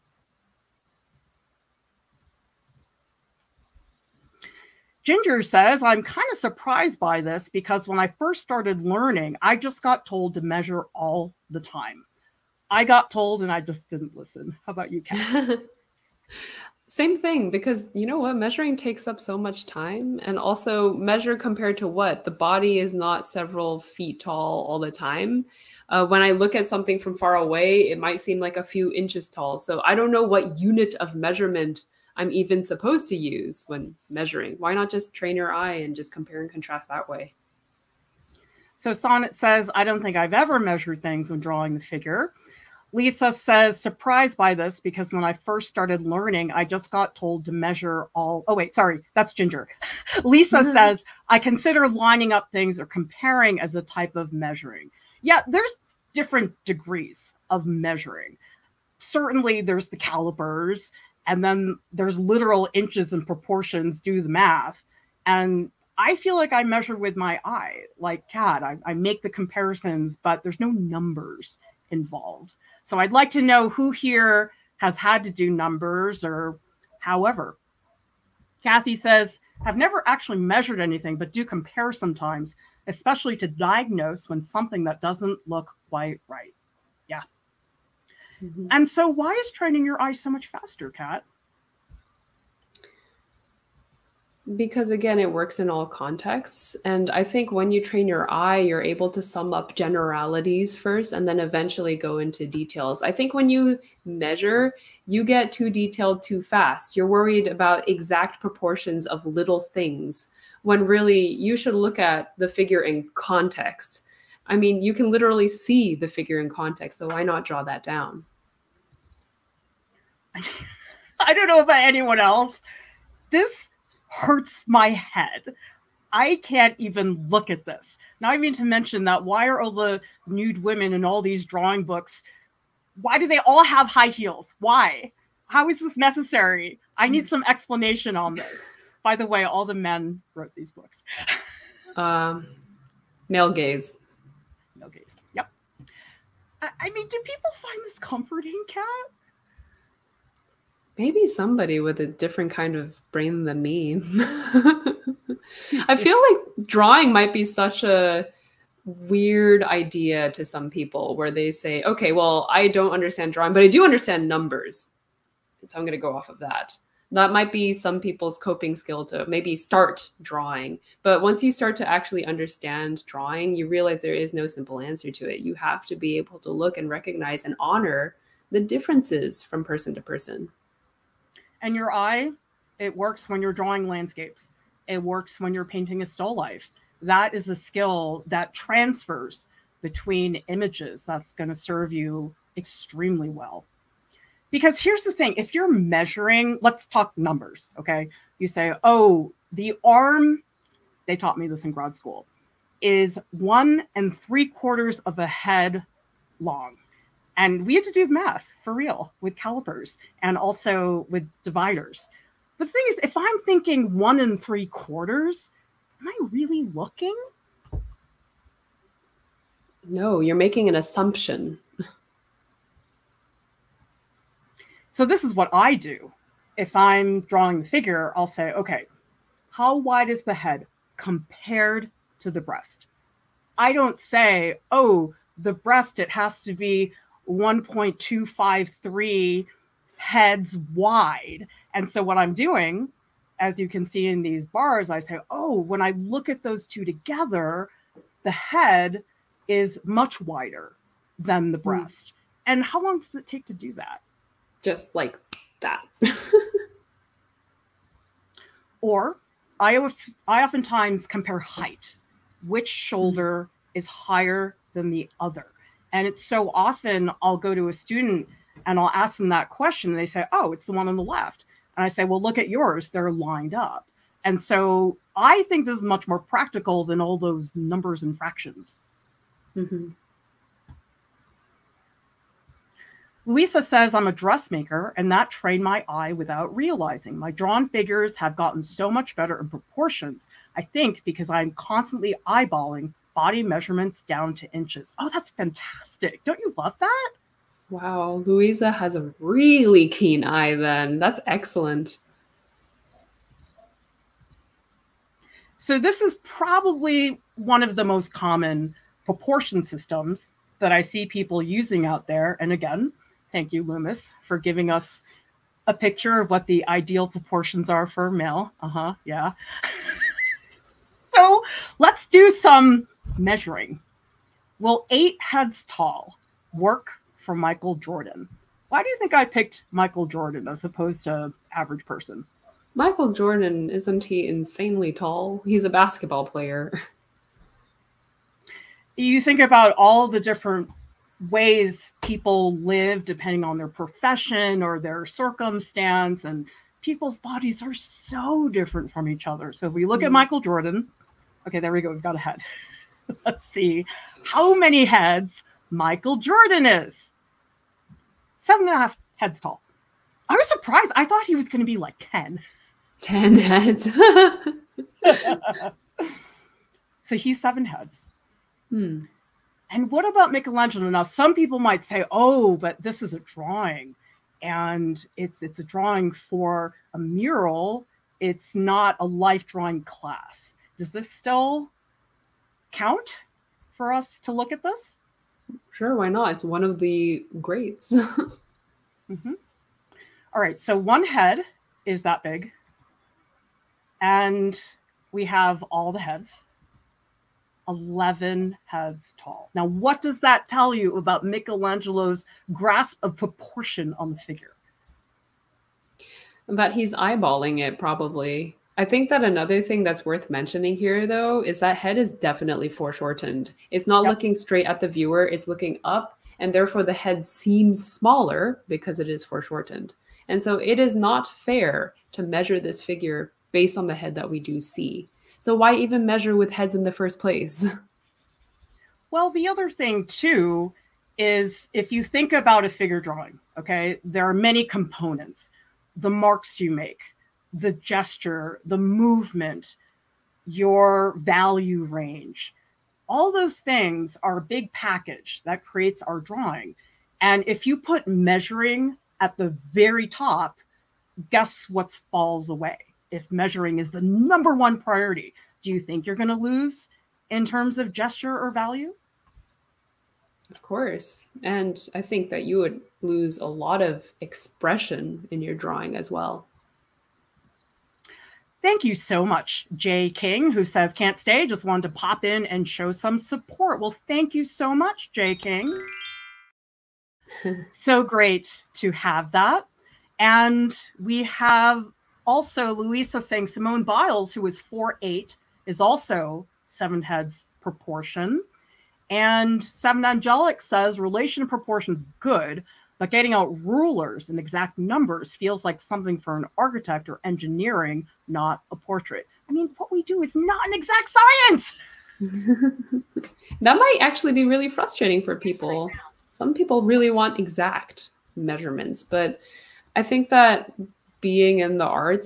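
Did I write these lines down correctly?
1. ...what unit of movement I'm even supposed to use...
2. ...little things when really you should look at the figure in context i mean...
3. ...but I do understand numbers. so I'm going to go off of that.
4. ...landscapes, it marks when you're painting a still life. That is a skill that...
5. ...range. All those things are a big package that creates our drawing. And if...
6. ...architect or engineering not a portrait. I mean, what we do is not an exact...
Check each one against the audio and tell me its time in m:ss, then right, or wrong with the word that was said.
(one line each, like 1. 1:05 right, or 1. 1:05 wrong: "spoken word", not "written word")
1. 0:30 wrong: "measurement", not "movement"
2. 1:49 right
3. 2:43 right
4. 3:03 wrong: "works", not "marks"
5. 7:21 right
6. 8:16 right.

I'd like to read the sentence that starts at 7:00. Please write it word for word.
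And so it is not fair to measure this figure based on the head that we do see.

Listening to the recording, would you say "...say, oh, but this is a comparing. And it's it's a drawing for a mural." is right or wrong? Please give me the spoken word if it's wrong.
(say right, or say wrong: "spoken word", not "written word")
wrong: "drawing", not "comparing".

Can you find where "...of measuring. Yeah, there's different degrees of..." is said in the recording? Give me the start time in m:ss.
0:54.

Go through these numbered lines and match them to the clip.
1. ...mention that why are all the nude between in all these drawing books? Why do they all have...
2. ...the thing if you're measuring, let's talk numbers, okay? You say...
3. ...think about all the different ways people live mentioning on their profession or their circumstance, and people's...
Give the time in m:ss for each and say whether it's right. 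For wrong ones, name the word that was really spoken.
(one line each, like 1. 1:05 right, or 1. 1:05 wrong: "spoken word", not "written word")
1. 2:08 wrong: "women", not "between"
2. 3:15 right
3. 5:39 wrong: "depending", not "mentioning".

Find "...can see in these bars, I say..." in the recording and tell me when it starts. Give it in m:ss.
4:03.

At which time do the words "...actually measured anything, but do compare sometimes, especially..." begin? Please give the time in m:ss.
1:20.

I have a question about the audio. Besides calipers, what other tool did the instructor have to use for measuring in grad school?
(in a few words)
dividers.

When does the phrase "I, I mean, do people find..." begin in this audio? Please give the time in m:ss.
2:26.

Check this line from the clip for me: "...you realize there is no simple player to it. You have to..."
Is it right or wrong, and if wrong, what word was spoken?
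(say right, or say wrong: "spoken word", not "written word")
wrong: "answer", not "player".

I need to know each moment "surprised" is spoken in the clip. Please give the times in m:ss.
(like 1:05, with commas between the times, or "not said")
0:06, 0:43, 6:00.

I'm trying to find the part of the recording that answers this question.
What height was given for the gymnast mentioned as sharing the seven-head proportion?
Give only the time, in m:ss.
8:04.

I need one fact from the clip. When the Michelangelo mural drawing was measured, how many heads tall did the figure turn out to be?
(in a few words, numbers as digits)
11.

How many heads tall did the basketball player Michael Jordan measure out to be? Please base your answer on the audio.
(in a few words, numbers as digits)
7 and a half.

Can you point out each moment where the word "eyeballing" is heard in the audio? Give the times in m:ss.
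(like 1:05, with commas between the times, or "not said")
4:52, 6:46.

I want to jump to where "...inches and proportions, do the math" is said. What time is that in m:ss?
1:02.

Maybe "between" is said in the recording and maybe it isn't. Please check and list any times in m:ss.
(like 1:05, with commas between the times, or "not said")
3:09.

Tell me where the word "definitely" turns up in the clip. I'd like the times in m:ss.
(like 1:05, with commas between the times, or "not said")
6:52.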